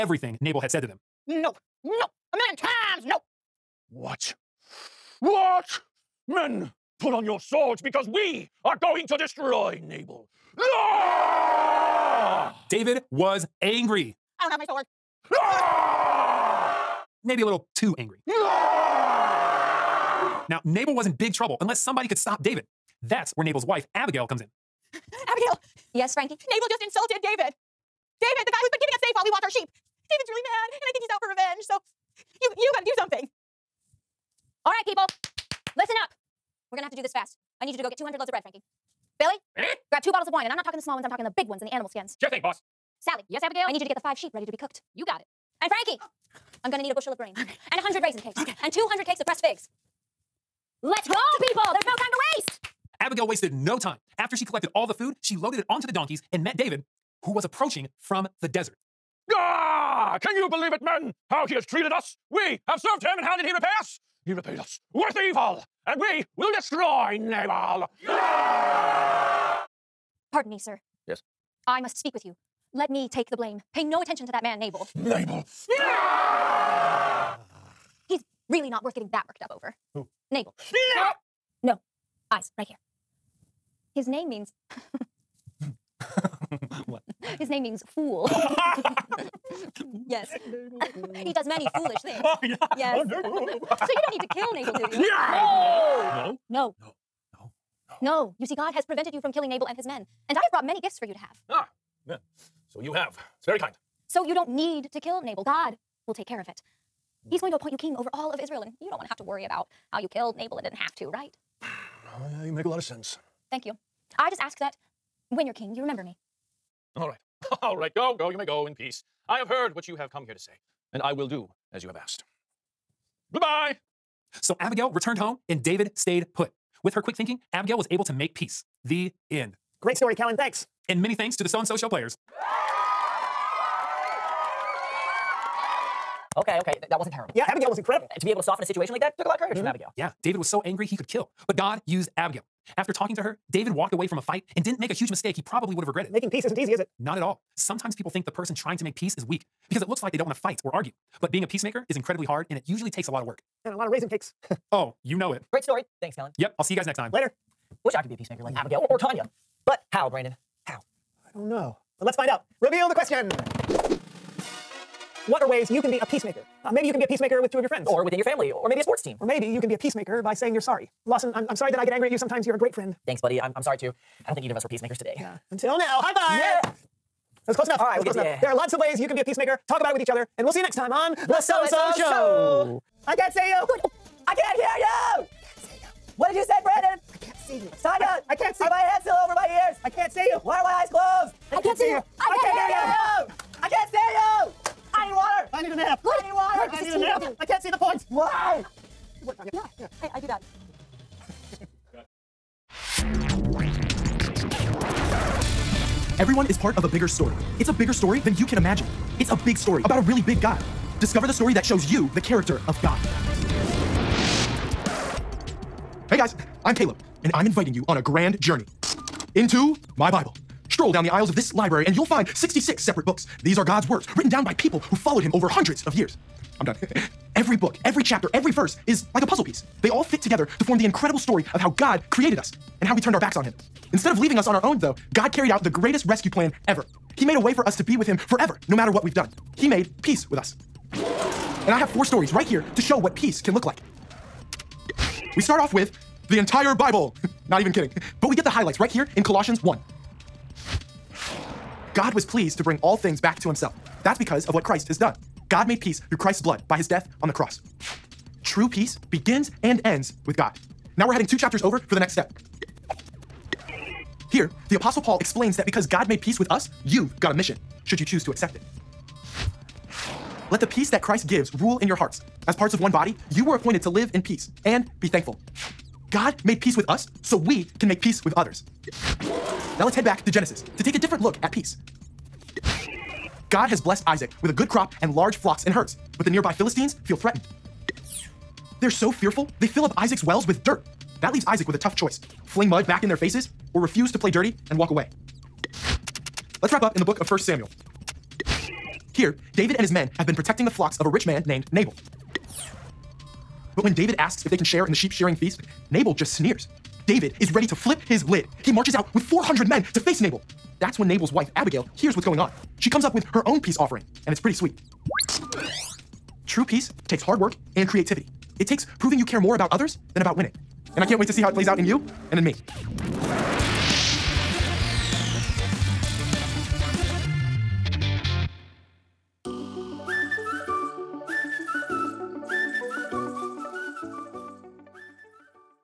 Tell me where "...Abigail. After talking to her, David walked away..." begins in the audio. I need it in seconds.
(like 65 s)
142 s.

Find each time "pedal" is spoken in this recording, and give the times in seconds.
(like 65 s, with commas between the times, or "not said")
not said.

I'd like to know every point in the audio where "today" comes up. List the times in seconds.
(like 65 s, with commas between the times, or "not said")
174 s.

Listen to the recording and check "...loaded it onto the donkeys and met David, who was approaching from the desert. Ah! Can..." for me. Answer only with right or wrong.
right.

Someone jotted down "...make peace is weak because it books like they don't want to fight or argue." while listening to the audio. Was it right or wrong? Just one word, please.
wrong.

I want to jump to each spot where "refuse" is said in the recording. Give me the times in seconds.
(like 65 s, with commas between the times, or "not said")
293 s.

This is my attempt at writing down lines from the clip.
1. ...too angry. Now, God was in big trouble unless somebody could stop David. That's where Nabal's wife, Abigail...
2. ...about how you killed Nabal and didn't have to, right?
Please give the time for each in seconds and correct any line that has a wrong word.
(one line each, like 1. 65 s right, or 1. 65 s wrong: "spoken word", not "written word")
1. 17 s wrong: "Nabal", not "God"
2. 109 s right.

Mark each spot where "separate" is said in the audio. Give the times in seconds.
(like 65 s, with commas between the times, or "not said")
222 s.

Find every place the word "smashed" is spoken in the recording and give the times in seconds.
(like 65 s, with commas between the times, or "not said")
not said.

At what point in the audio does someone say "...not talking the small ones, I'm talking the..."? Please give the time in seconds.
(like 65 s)
40 s.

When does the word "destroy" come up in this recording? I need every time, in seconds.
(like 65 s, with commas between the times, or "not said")
9 s, 66 s.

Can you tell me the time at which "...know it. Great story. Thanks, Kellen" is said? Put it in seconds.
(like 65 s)
155 s.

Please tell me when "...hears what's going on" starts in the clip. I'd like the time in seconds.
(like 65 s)
311 s.